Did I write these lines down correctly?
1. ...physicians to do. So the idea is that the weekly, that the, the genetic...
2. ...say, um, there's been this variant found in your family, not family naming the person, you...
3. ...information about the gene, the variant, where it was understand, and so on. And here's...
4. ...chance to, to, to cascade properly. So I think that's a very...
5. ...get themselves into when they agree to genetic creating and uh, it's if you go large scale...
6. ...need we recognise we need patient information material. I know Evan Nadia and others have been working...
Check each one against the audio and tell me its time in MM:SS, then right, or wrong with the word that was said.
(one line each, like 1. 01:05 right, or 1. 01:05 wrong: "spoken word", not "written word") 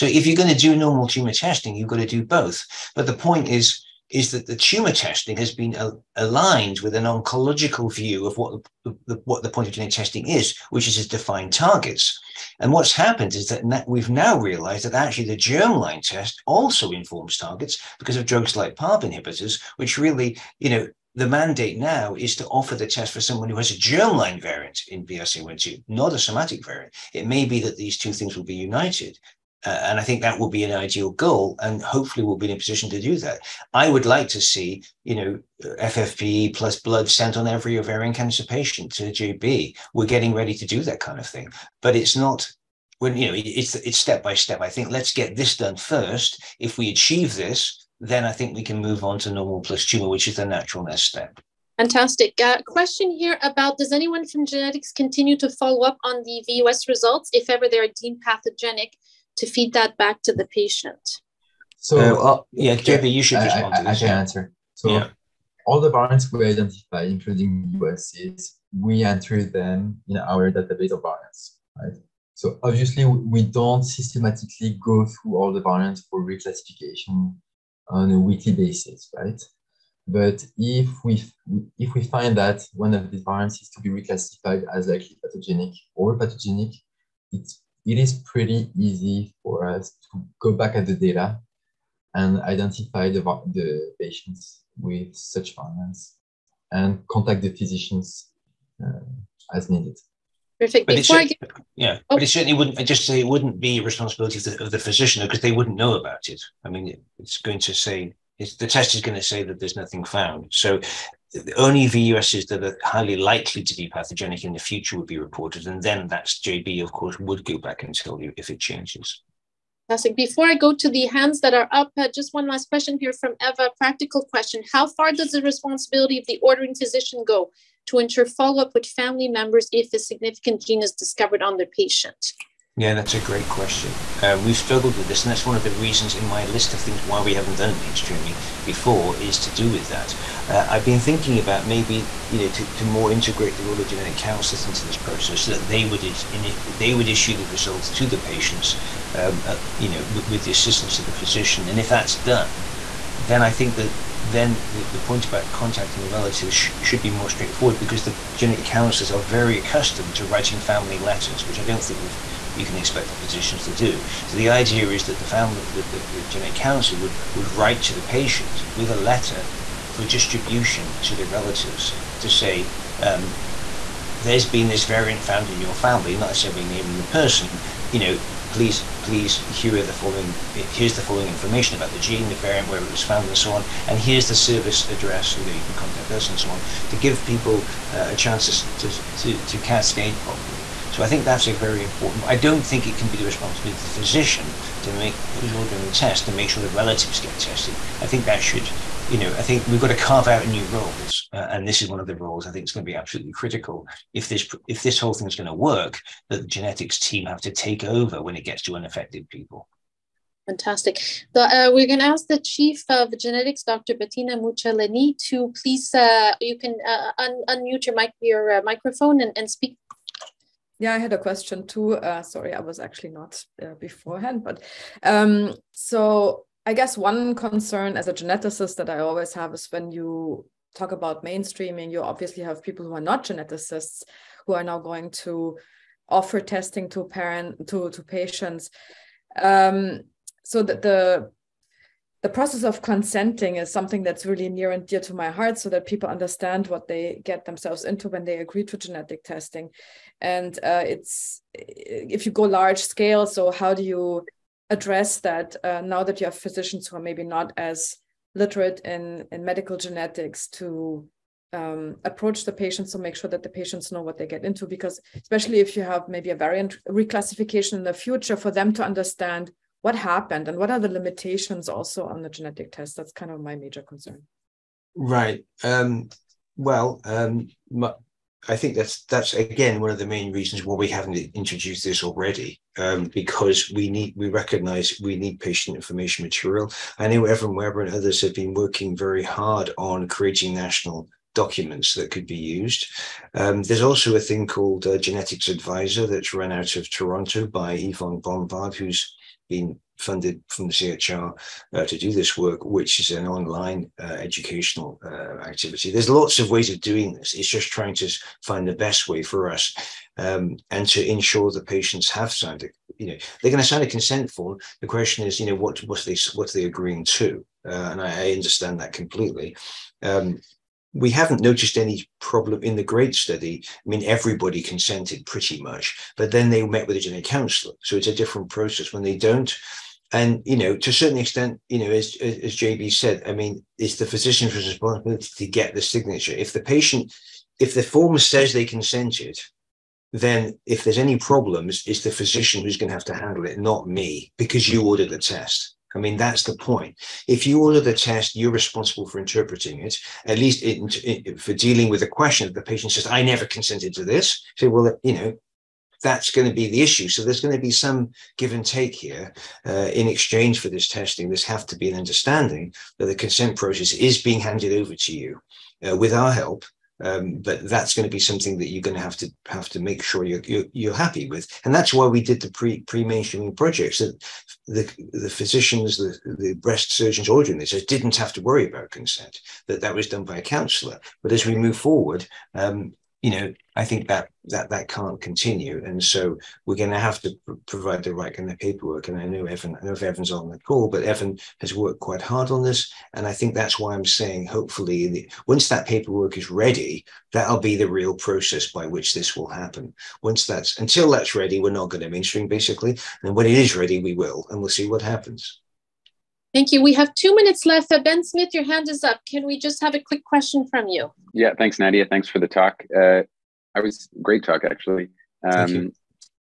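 1. 02:43 wrong: "family", not "weekly"
2. 02:52 wrong: "necessarily", not "family"
3. 03:01 wrong: "found", not "understand"
4. 03:08 right
5. 04:07 wrong: "testing", not "creating"
6. 04:43 wrong: "Weber", not "Nadia".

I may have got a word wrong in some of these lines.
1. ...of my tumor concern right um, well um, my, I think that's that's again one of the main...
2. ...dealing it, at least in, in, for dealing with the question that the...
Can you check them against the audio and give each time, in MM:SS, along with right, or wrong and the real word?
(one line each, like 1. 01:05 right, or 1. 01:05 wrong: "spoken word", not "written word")
1. 04:33 wrong: "major", not "tumor"
2. 05:49 wrong: "interpreting", not "dealing".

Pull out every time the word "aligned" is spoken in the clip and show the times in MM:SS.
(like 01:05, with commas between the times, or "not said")
00:06.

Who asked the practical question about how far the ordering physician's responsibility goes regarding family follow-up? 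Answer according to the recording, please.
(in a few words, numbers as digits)
Eva.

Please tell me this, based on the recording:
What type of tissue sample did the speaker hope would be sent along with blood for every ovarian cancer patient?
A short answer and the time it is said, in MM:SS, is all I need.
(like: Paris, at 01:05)
FFPE, at 00:35.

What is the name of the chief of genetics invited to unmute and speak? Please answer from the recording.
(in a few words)
Bettina Mucciolini.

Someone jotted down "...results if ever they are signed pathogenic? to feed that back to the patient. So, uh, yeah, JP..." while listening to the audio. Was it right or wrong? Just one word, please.
wrong.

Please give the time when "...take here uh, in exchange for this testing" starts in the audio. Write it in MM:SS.
05:58.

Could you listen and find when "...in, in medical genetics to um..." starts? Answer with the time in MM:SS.
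04:18.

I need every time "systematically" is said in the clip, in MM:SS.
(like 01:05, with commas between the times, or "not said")
01:13.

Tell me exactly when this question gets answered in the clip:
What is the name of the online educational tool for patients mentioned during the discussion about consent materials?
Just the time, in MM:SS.
04:55.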